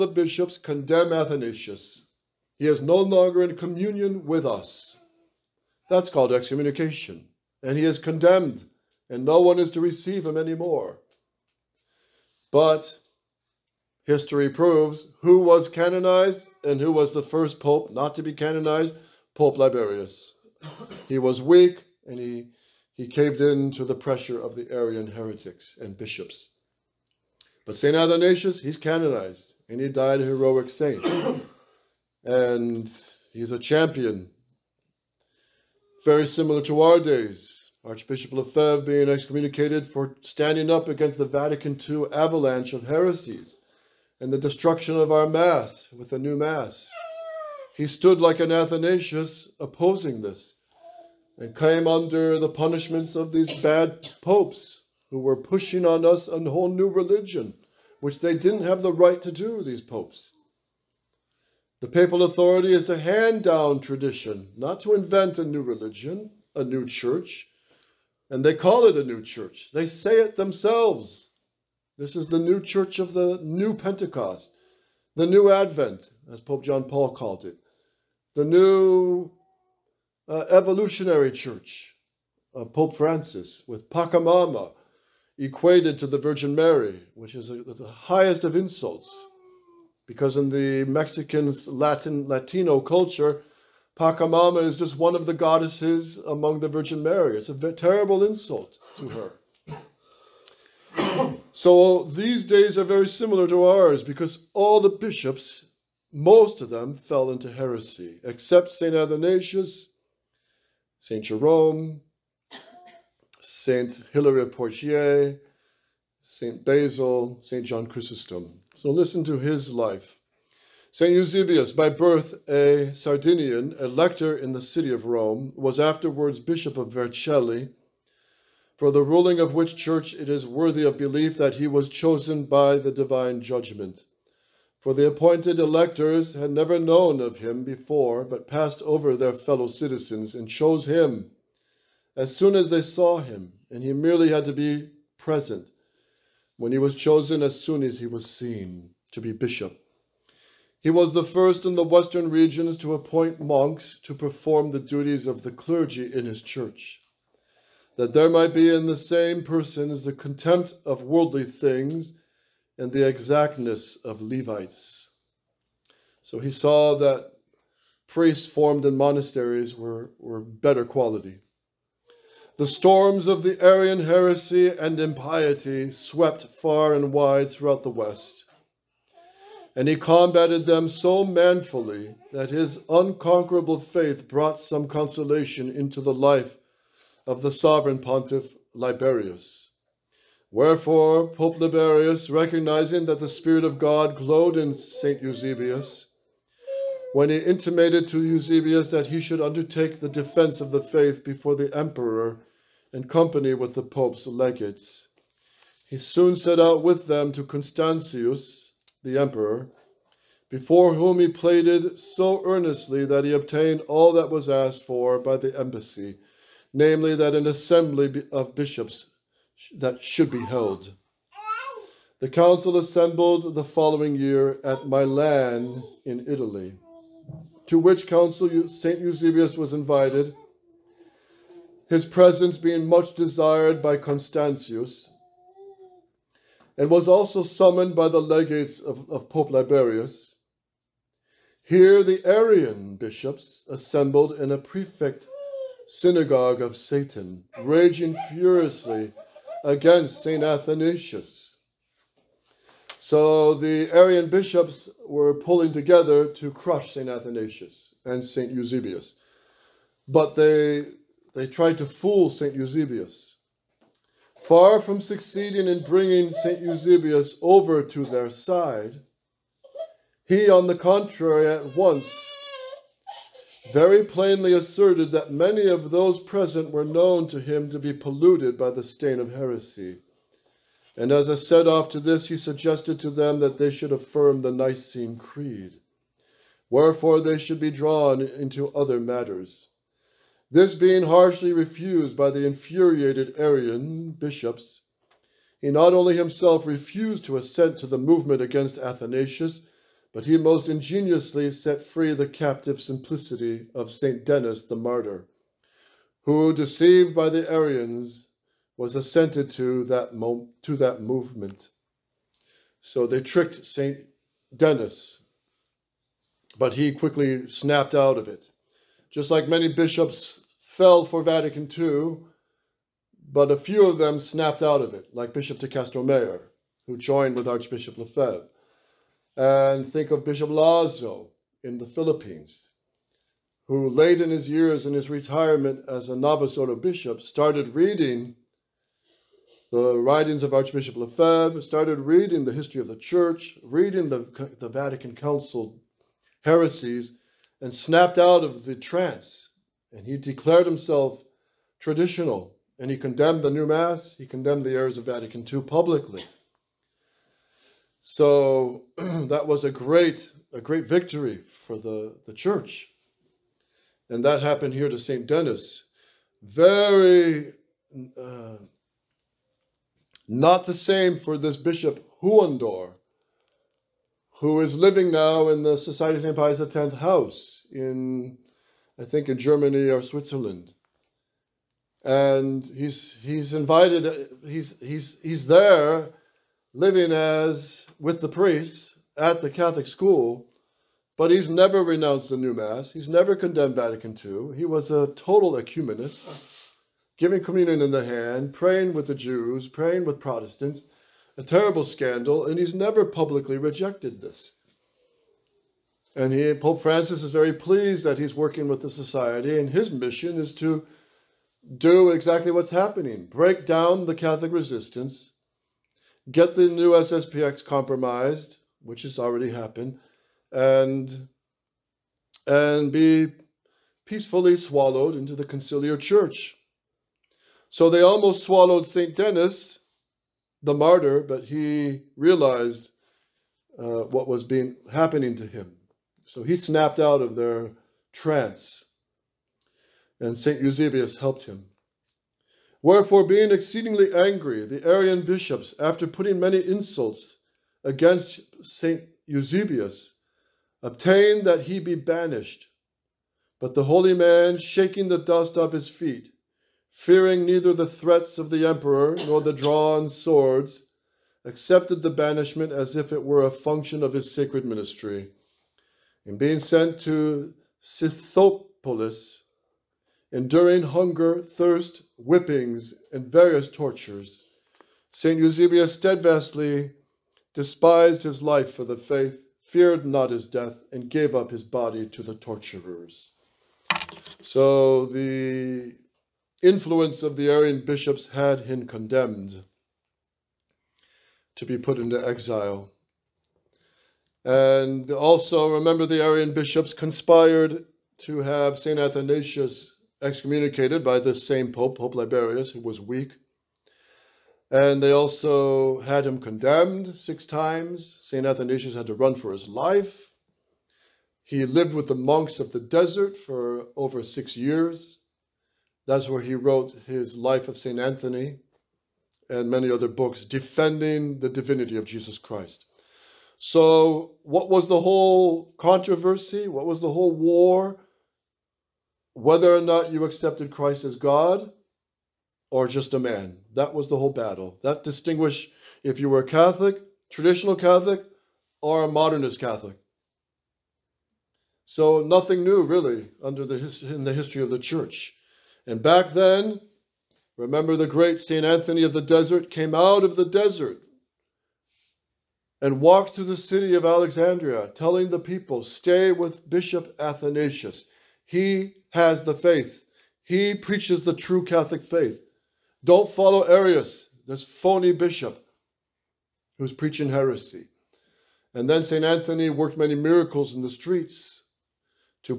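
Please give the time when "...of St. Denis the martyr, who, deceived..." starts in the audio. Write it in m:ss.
5:03.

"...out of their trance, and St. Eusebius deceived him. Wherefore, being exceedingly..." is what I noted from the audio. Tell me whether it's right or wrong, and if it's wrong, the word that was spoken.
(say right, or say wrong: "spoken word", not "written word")
wrong: "helped", not "deceived".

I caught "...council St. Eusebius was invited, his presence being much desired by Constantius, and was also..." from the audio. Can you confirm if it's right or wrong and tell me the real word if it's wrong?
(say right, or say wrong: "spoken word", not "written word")
right.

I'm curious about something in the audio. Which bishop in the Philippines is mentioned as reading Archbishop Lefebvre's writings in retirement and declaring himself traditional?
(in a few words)
Bishop Lazo.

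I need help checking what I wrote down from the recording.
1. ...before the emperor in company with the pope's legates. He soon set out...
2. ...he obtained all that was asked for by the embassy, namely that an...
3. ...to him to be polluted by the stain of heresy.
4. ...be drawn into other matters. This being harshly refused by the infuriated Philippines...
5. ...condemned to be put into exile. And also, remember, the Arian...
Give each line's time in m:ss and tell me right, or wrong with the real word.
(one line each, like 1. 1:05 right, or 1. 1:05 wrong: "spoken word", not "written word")
1. 3:21 right
2. 3:33 right
3. 4:37 right
4. 4:47 wrong: "Arian", not "Philippines"
5. 8:08 right.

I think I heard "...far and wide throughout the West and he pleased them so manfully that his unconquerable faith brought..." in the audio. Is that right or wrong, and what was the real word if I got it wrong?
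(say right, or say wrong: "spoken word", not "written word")
wrong: "combated", not "pleased".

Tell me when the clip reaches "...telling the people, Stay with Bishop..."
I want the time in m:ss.
9:14.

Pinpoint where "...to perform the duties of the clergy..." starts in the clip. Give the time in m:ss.
2:34.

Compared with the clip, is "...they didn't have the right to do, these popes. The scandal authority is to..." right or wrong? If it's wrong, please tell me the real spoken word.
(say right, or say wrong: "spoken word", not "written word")
wrong: "papal", not "scandal".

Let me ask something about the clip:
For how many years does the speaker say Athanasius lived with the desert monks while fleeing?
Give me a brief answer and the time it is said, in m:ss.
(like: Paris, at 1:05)
6, at 8:34.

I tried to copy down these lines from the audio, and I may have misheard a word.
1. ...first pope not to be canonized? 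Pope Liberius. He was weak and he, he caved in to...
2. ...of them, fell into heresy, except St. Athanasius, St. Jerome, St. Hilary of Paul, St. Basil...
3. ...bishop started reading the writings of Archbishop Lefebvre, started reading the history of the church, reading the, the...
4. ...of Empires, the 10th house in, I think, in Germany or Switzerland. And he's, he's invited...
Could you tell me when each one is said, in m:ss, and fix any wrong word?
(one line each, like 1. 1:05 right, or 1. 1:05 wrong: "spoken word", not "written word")
1. 0:17 right
2. 1:46 wrong: "Poitiers", not "Paul"
3. 5:36 right
4. 6:16 right.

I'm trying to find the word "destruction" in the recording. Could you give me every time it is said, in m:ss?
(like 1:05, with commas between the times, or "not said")
0:44.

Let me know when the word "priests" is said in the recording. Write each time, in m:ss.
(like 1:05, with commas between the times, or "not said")
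2:48, 6:28.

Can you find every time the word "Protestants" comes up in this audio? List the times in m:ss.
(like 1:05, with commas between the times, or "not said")
6:40.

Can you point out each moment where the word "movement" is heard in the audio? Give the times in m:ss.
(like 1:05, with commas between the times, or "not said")
4:57, 5:11.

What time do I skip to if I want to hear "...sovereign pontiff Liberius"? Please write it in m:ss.
3:07.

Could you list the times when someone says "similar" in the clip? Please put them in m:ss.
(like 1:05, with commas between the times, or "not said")
0:36, 1:43.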